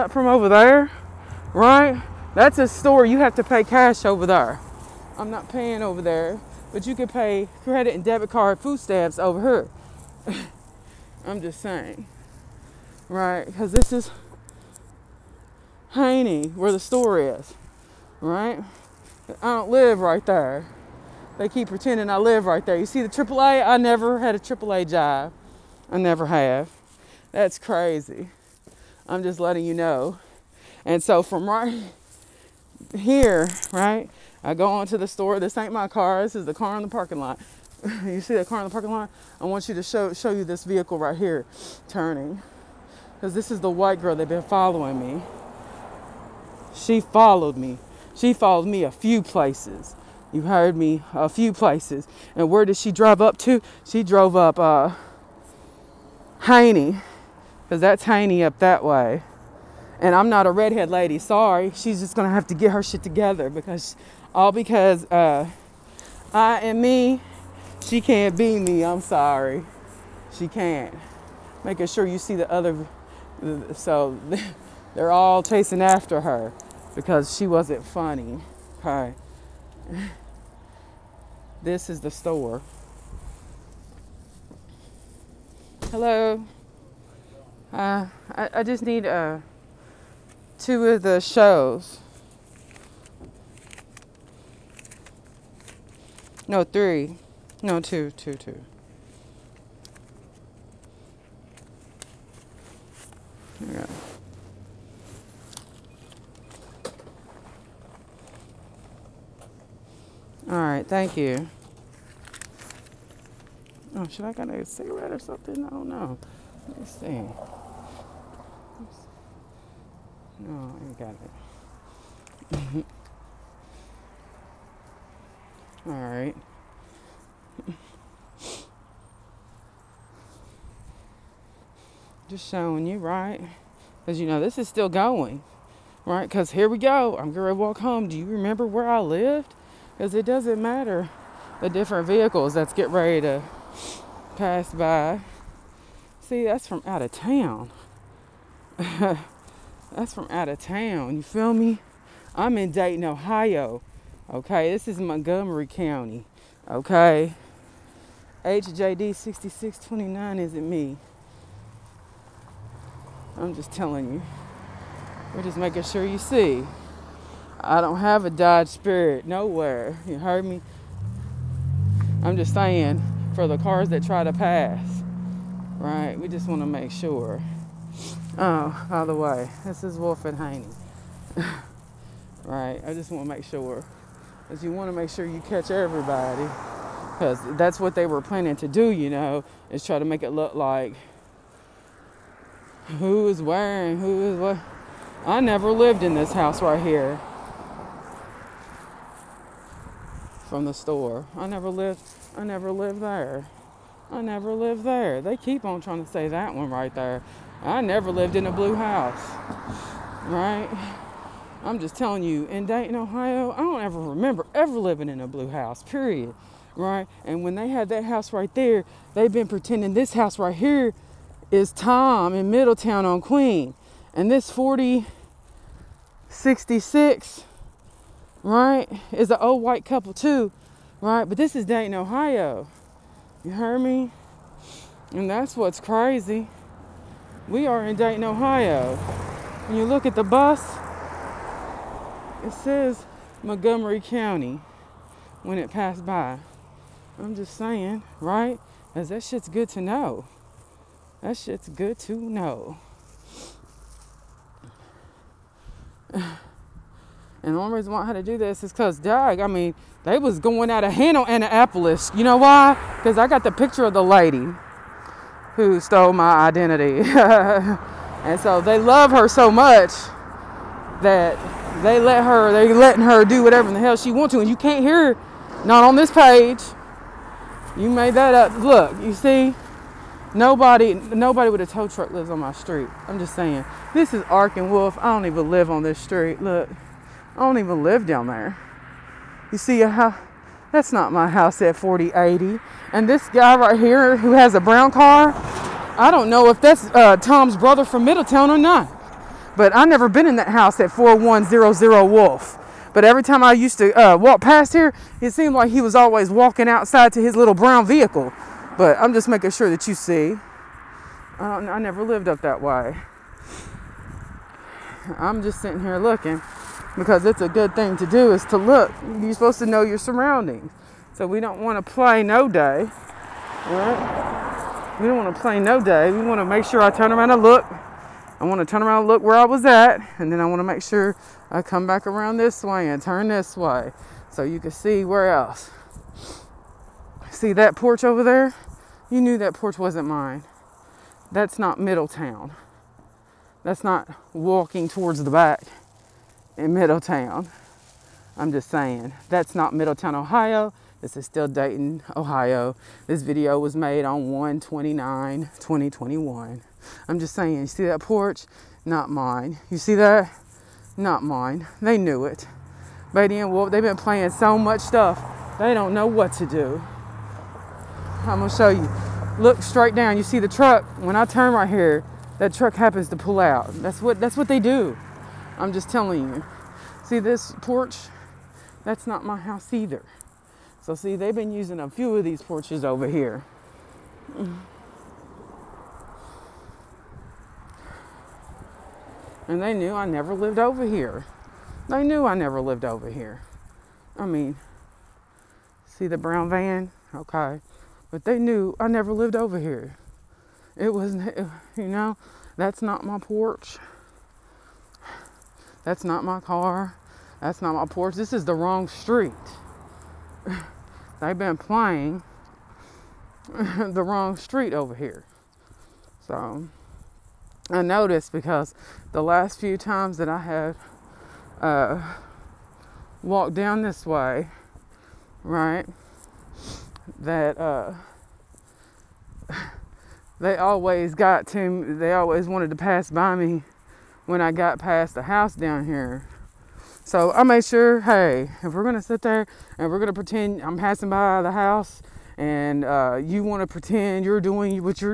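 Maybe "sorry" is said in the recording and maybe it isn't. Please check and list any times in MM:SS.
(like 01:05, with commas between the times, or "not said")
01:01, 01:09.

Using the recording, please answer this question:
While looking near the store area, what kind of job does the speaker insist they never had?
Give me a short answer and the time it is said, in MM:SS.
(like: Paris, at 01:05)
AAA job, at 00:24.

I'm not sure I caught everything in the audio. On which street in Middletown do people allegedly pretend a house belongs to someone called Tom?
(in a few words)
Queen.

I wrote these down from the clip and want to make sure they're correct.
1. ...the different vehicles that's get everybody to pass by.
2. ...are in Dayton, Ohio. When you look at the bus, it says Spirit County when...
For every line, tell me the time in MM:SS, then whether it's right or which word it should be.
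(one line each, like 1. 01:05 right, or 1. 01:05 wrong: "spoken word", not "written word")
1. 02:21 wrong: "ready", not "everybody"
2. 03:57 wrong: "Montgomery", not "Spirit".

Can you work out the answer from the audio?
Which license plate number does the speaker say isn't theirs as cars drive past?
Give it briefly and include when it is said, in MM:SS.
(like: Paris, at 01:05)
HJD 6629, at 02:38.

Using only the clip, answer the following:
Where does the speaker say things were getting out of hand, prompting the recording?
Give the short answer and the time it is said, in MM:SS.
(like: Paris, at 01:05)
Annapolis, at 04:21.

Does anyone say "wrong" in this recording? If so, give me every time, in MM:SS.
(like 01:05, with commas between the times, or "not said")
06:48, 06:54.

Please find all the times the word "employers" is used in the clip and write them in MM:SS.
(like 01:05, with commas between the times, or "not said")
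not said.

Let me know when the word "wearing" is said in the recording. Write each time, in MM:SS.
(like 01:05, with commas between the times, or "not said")
03:13.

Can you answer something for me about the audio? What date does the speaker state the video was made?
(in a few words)
1/29/2021.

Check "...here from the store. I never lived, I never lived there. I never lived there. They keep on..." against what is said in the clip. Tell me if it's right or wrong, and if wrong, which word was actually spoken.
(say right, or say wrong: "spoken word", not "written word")
right.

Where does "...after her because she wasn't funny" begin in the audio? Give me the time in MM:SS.
01:15.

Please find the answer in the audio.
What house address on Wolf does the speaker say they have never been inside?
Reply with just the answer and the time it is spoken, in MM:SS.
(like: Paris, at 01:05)
4100 Wolf, at 05:00.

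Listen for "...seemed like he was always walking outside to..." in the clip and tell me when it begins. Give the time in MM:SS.
05:05.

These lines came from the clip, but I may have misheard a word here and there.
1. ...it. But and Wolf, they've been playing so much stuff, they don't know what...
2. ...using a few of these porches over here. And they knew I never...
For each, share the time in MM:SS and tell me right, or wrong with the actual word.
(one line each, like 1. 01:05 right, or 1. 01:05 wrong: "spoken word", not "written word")
1. 06:02 right
2. 06:21 right.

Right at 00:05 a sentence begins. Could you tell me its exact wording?
I'm not paying over there but you can pay credit and debit card food stamps over here.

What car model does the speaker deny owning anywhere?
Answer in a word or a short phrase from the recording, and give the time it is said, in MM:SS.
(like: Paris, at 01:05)
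Dodge Spirit, at 02:48.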